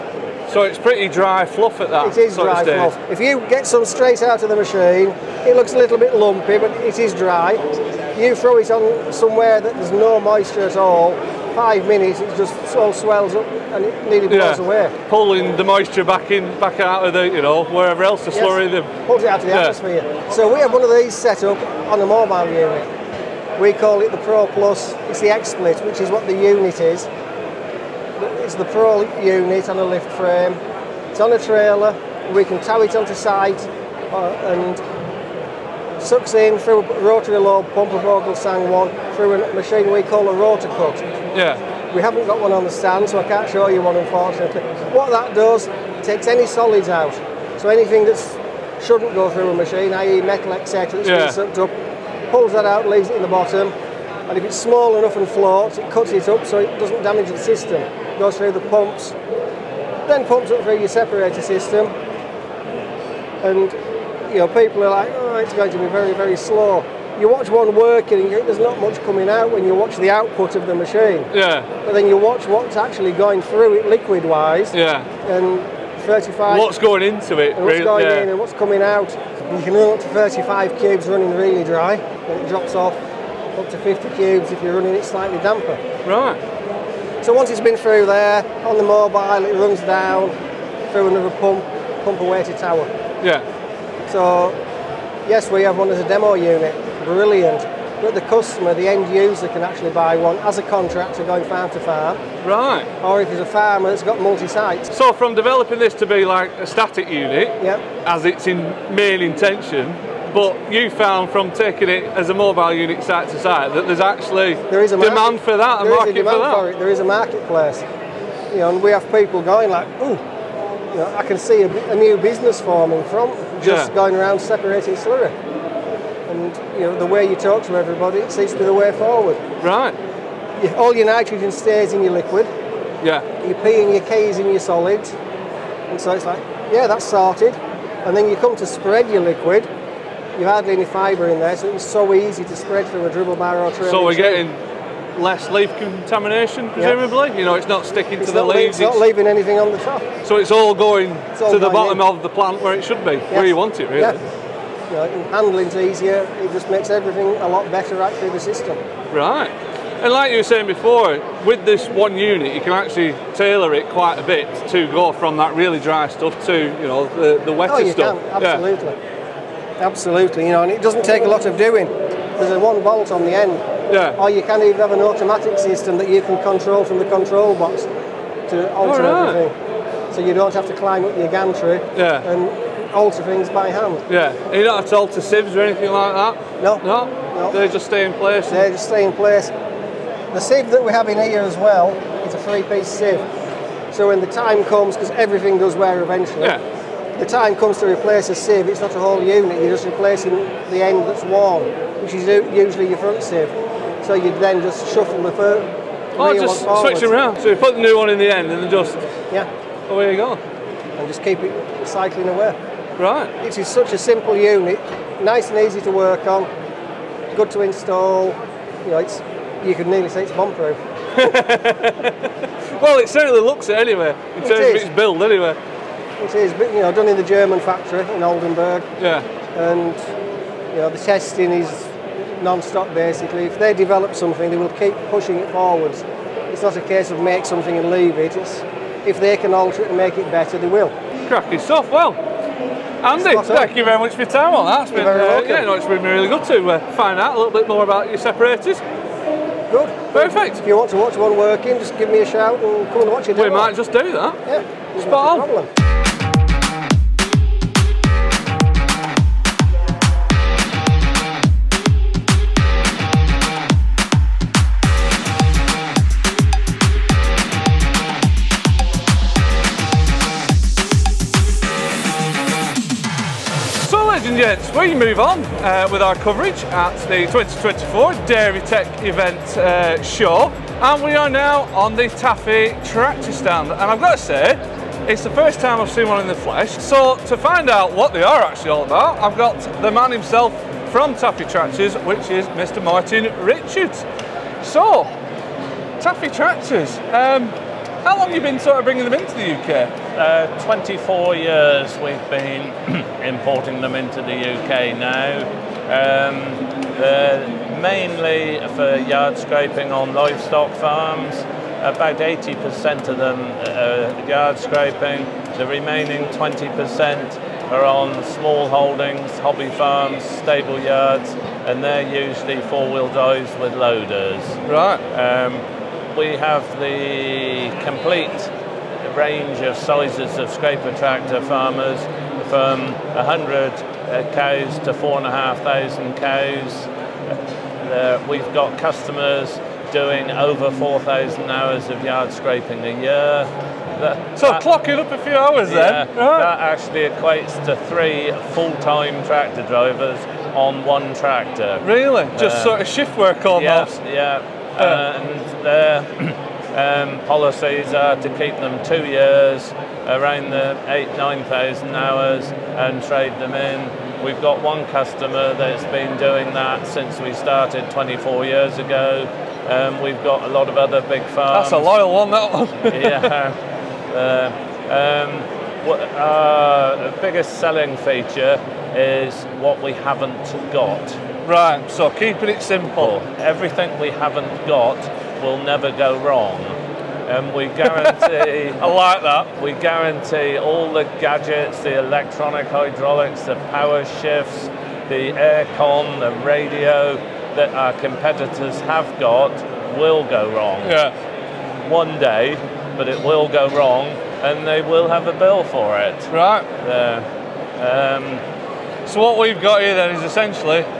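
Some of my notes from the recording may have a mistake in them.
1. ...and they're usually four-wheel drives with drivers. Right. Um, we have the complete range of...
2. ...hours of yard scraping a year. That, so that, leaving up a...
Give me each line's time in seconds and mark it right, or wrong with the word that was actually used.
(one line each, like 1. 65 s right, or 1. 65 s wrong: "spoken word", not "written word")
1. 321 s wrong: "loaders", not "drivers"
2. 341 s wrong: "clocking", not "leaving".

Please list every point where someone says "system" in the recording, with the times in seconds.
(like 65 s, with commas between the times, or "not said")
57 s, 61 s, 158 s, 175 s.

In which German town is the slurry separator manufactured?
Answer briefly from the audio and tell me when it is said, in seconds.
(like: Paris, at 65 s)
Oldenburg, at 228 s.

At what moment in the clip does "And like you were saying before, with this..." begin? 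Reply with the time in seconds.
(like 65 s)
160 s.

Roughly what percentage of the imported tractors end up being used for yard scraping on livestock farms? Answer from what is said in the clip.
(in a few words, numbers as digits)
80%.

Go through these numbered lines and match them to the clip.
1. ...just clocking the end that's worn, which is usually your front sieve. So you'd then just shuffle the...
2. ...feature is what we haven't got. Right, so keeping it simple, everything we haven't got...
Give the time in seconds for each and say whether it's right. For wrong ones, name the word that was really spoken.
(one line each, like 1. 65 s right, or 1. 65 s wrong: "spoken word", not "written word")
1. 199 s wrong: "replacing", not "clocking"
2. 377 s right.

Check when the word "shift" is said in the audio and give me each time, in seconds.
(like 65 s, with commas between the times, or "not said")
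352 s, 394 s.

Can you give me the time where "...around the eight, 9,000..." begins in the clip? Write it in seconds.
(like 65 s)
360 s.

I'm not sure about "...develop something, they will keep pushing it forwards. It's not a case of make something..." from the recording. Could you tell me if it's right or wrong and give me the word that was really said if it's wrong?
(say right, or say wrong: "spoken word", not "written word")
right.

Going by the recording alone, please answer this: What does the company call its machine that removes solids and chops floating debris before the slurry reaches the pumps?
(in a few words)
RotaCut.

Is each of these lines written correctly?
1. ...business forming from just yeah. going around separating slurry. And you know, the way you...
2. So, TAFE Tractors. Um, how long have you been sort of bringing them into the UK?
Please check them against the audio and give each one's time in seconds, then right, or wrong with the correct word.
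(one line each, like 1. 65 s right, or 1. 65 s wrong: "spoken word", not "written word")
1. 122 s right
2. 294 s right.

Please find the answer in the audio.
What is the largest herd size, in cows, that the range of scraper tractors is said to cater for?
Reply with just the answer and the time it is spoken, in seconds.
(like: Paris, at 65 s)
4,500, at 334 s.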